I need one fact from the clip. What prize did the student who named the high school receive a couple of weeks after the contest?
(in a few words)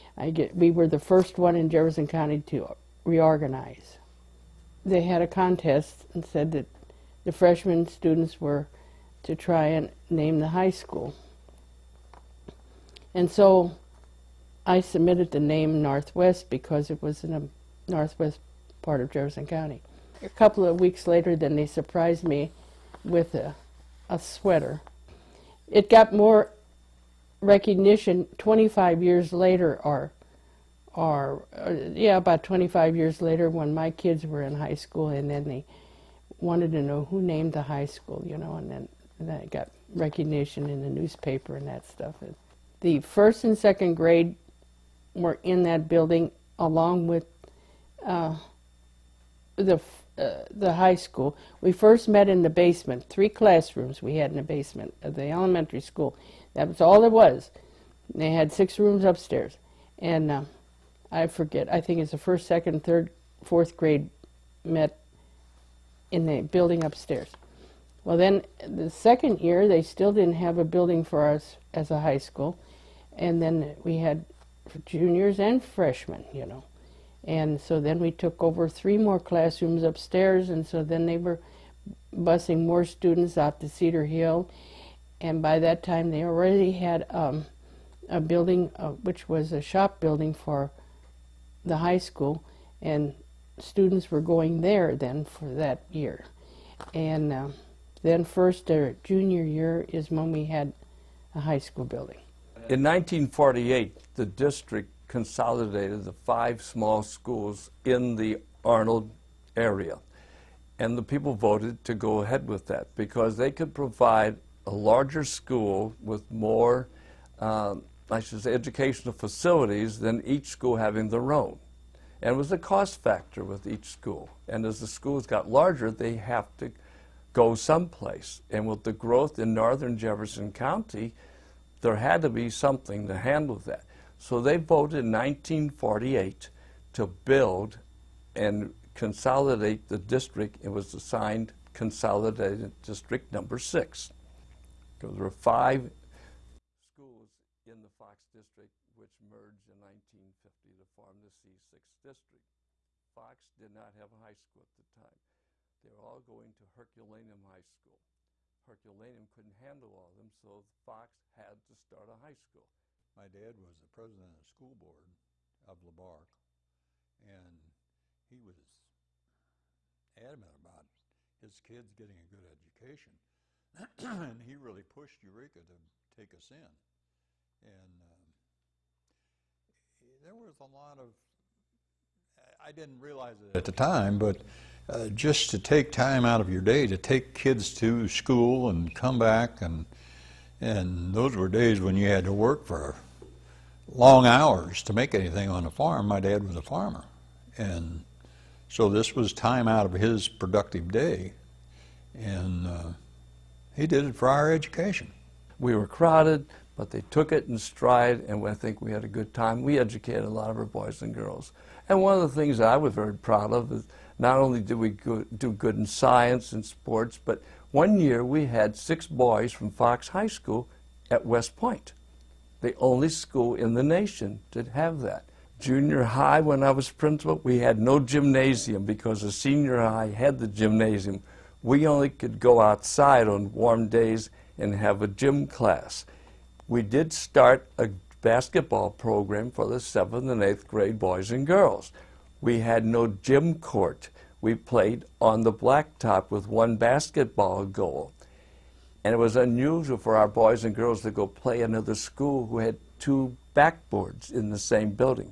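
A sweater.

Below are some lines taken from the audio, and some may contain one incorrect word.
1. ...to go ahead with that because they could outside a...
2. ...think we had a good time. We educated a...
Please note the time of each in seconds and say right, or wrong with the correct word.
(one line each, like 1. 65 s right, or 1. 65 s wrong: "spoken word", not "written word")
1. 111 s wrong: "provide", not "outside"
2. 208 s right.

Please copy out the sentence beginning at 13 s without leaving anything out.
And so I submitted the name Northwest because it was in the northwest part of Jefferson County.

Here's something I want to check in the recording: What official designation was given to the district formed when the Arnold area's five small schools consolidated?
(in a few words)
Consolidated District Number Six.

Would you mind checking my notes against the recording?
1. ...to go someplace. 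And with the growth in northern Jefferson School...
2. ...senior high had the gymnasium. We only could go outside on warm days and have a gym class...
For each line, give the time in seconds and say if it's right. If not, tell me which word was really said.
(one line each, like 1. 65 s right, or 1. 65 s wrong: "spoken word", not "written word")
1. 126 s wrong: "County", not "School"
2. 229 s right.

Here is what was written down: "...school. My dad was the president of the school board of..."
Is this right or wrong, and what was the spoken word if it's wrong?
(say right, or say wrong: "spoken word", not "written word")
right.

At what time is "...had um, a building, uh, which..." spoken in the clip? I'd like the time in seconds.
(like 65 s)
86 s.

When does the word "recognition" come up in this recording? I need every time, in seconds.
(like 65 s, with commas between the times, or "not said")
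27 s, 39 s.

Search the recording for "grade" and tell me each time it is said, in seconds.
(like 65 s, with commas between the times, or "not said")
43 s, 63 s, 240 s.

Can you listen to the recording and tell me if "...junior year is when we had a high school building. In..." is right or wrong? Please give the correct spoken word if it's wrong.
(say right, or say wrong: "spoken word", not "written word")
right.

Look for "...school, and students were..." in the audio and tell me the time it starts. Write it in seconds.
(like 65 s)
91 s.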